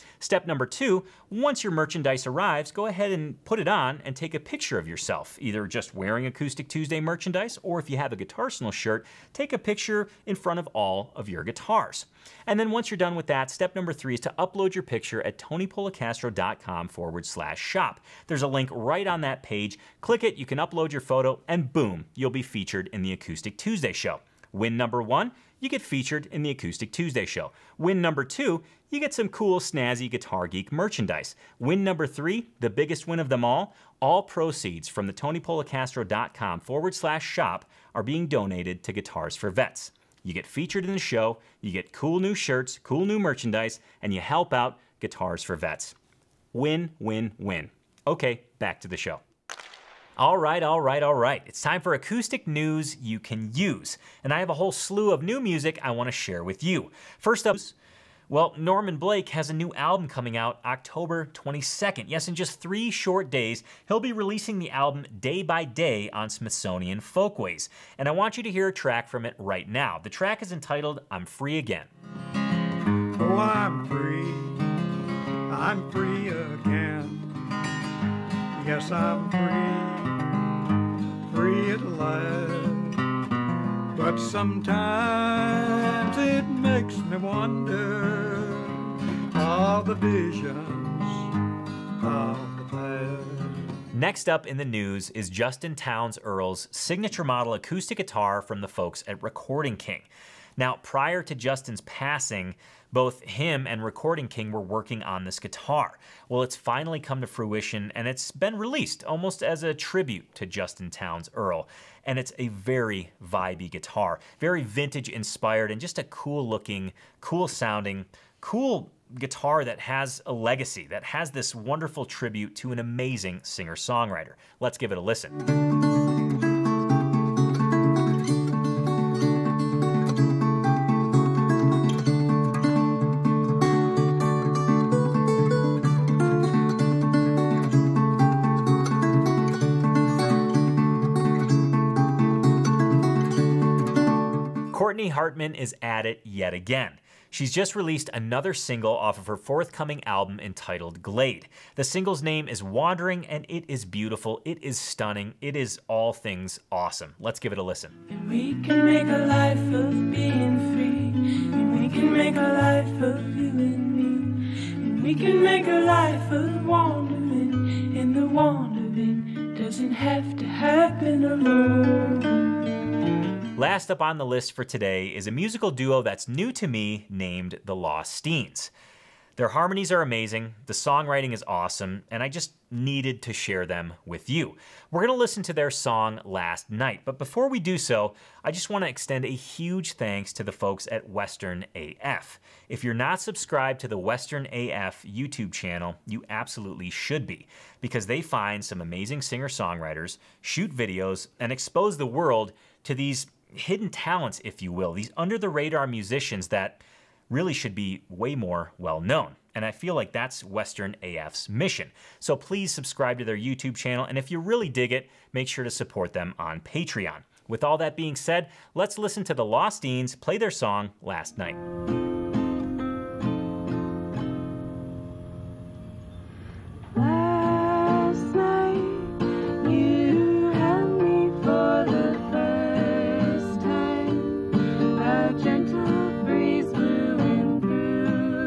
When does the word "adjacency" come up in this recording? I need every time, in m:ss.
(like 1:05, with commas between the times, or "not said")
not said.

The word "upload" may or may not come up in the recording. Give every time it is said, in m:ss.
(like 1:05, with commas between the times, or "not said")
0:14, 0:20.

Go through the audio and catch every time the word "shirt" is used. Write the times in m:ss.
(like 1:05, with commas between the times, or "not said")
0:08, 0:42.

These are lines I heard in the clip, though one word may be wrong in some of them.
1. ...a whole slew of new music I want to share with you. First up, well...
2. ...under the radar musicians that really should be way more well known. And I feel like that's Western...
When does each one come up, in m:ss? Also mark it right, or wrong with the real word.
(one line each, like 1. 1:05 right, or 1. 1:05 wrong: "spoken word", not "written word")
1. 0:54 right
2. 3:25 right.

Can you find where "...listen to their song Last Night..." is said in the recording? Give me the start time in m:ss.
3:05.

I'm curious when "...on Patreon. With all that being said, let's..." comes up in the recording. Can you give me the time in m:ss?
3:36.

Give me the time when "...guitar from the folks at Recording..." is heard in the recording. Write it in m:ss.
1:37.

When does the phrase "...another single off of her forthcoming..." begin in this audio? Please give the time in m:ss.
2:28.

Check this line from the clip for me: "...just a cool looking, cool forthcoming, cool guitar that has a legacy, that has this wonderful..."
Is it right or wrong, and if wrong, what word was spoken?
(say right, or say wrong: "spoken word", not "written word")
wrong: "sounding", not "forthcoming".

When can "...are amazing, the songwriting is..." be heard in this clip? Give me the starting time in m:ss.
2:59.